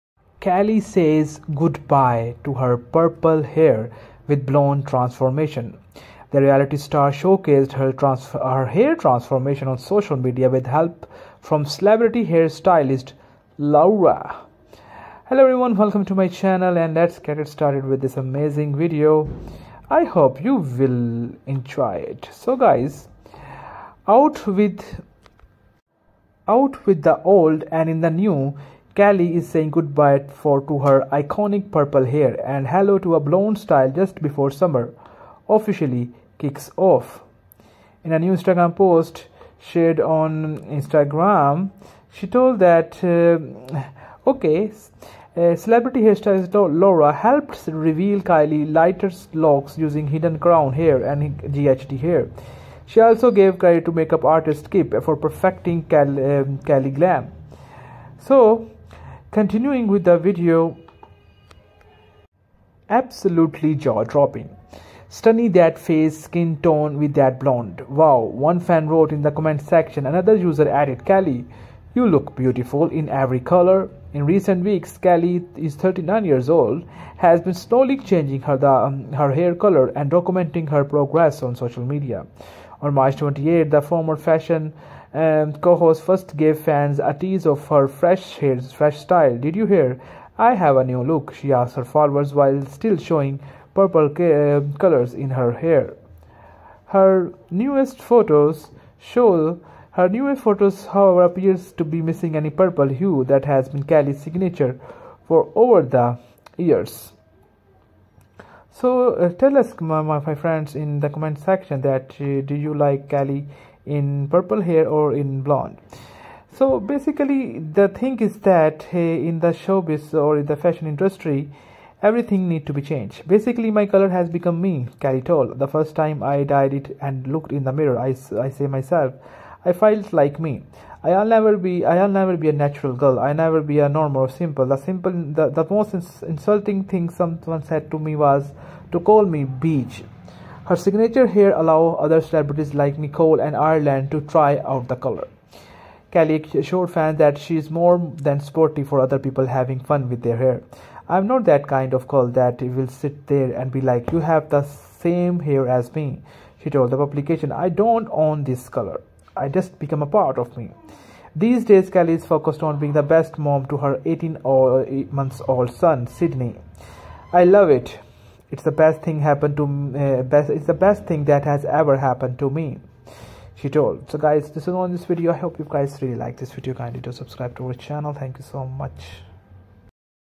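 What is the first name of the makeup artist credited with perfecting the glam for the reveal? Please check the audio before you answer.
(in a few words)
Kip.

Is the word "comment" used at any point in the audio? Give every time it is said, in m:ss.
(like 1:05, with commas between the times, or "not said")
1:09, 1:51.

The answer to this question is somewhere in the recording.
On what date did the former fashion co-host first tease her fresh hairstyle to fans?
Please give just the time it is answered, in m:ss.
1:22.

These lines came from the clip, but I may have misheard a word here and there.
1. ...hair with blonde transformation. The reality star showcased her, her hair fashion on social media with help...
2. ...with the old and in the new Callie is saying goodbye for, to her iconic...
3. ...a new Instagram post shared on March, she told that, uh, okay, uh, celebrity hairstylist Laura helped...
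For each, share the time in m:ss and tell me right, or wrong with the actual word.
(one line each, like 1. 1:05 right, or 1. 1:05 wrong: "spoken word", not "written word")
1. 0:03 wrong: "transformation", not "fashion"
2. 0:26 right
3. 0:38 wrong: "Instagram", not "March".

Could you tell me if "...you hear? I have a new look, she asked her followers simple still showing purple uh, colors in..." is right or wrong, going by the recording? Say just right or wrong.
wrong.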